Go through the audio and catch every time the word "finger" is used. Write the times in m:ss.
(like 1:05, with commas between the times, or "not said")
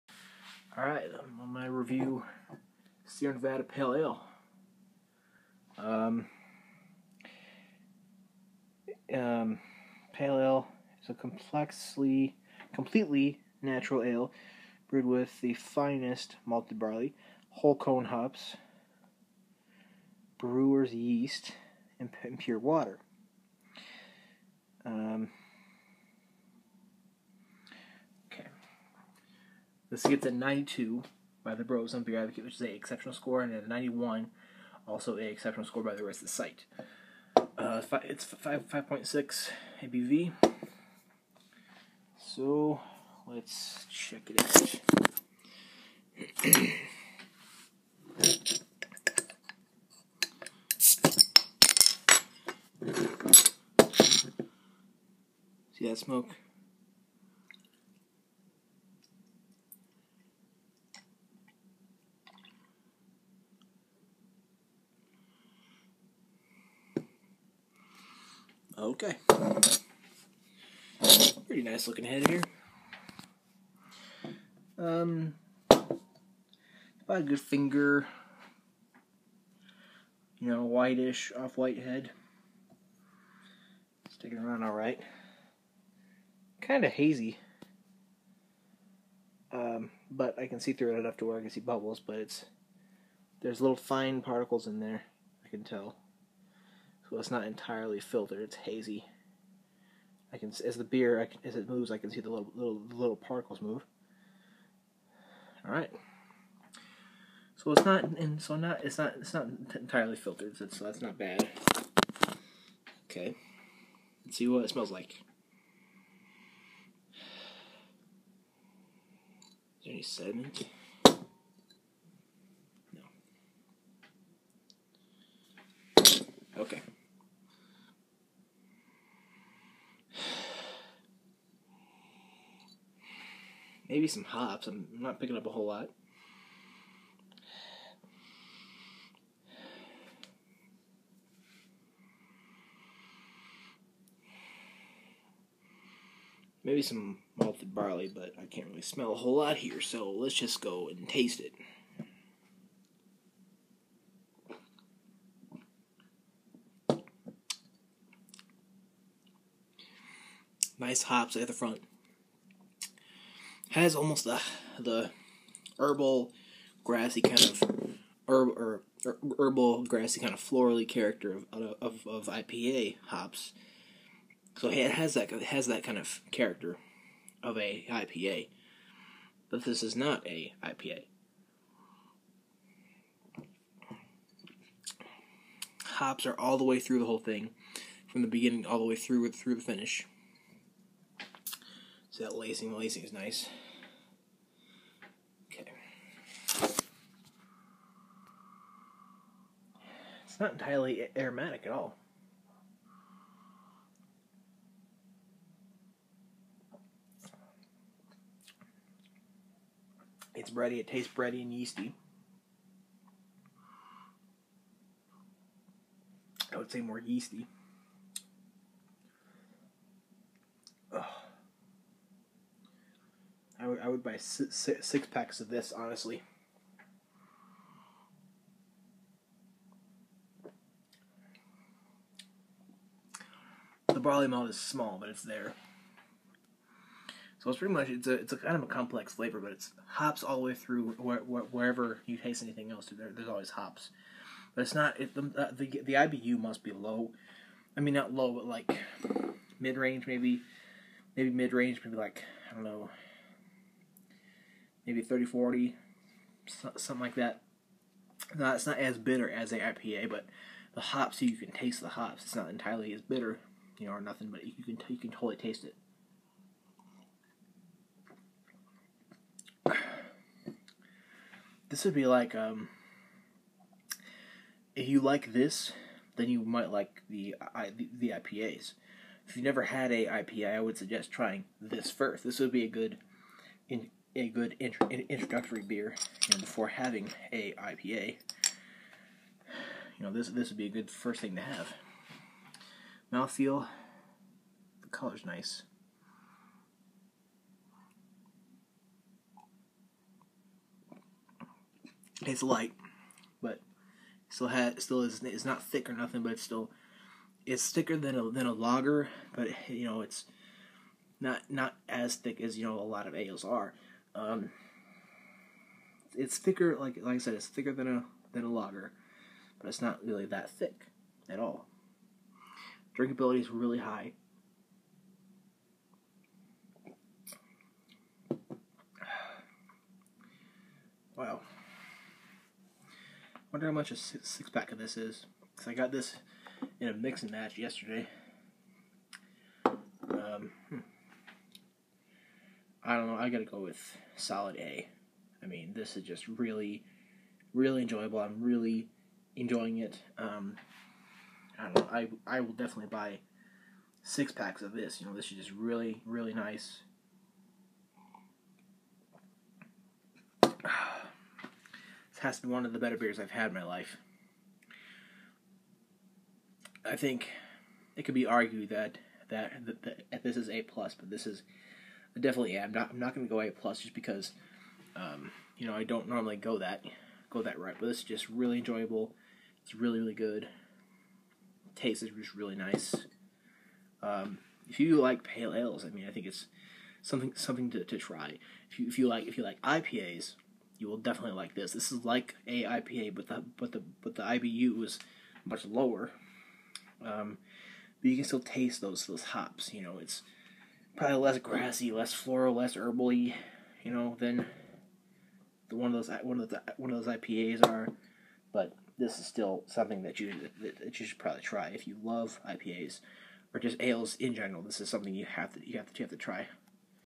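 1:17.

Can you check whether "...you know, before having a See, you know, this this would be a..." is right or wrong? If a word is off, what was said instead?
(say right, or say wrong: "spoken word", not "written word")
wrong: "IPA", not "See".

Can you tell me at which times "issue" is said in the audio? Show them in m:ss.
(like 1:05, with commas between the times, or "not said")
not said.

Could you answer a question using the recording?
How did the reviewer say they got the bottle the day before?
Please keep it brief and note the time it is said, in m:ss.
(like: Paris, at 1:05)
mix and match, at 5:36.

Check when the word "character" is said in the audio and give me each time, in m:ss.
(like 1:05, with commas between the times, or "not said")
2:50, 2:56.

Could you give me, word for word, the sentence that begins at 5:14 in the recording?
Um, it's thicker, like like I said, it's thicker than a than a lager, but it's not really that thick at all.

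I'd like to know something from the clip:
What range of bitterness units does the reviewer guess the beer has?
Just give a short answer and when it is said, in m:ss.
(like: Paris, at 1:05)
30 to 40, at 4:15.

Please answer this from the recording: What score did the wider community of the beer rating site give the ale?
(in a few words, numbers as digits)
91.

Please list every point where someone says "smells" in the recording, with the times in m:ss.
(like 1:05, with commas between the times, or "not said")
1:54, 2:28.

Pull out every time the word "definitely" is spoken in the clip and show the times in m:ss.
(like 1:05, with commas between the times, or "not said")
5:52, 6:12, 6:30.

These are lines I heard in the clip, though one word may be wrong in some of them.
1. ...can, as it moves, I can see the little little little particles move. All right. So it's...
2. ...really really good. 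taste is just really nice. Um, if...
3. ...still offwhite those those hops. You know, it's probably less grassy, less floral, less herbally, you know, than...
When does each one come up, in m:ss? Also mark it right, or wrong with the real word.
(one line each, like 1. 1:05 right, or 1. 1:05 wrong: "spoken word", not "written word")
1. 1:41 right
2. 6:19 right
3. 6:38 wrong: "taste", not "offwhite".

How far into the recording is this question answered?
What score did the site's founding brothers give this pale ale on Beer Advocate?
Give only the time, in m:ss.
0:30.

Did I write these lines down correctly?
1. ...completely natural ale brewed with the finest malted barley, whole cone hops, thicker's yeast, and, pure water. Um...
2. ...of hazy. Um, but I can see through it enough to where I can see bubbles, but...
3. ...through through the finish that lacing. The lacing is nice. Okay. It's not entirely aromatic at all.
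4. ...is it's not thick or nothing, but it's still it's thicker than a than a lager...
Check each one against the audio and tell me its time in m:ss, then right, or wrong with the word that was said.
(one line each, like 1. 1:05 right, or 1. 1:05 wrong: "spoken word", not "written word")
1. 0:12 wrong: "brewer", not "thicker"
2. 1:26 right
3. 3:08 right
4. 5:05 right.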